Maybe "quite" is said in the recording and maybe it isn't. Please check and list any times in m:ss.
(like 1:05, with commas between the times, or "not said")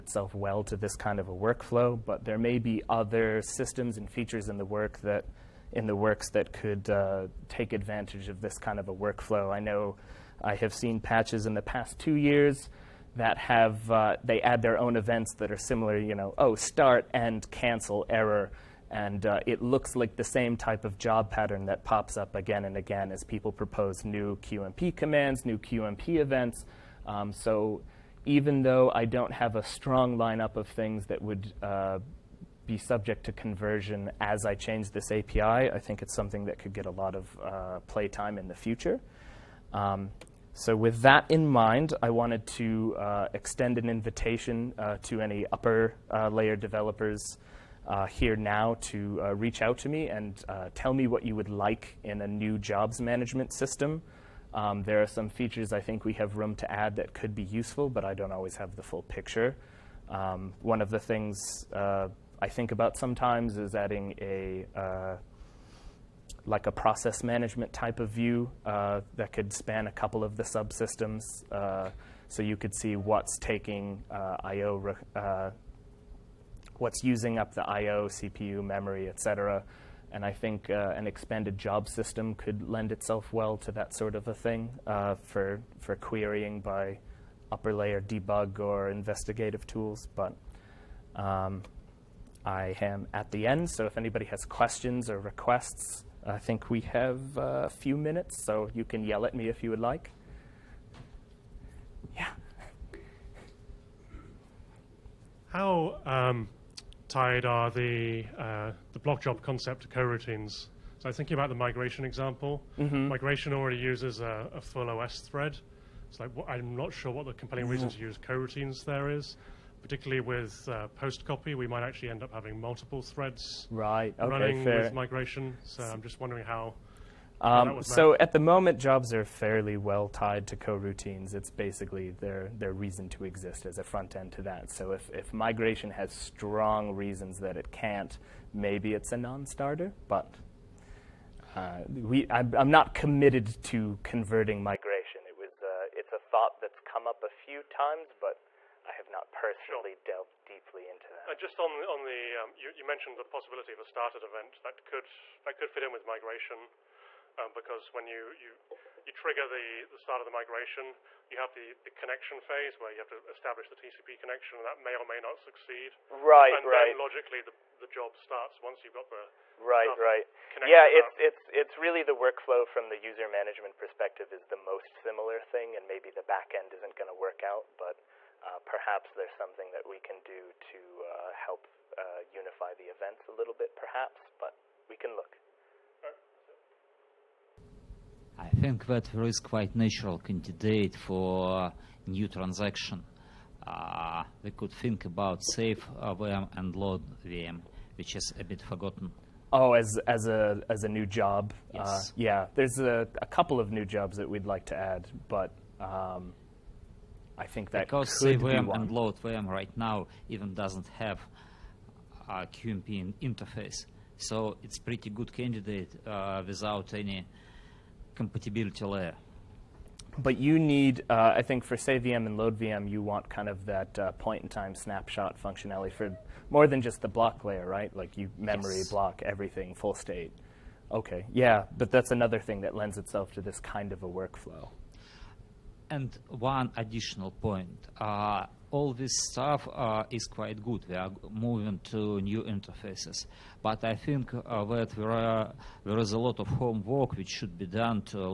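3:09, 4:00.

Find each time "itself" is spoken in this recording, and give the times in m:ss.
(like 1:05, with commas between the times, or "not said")
1:22, 3:52.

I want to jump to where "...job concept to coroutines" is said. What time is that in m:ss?
1:49.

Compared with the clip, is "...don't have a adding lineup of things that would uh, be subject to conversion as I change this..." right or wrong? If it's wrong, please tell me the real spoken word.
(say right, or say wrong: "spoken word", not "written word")
wrong: "strong", not "adding".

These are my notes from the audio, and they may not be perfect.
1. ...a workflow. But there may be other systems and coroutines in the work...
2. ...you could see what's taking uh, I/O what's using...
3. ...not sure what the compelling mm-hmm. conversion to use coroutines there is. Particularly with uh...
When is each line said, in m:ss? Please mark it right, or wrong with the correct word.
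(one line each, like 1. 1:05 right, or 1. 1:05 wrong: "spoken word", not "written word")
1. 0:01 wrong: "features", not "coroutines"
2. 1:12 right
3. 1:56 wrong: "reason", not "conversion".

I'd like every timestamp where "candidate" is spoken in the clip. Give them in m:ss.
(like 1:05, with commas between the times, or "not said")
3:10, 3:35.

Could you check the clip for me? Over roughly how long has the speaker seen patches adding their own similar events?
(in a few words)
2 years.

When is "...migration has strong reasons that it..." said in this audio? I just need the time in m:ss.
2:15.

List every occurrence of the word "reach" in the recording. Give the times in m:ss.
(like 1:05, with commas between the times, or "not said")
0:49.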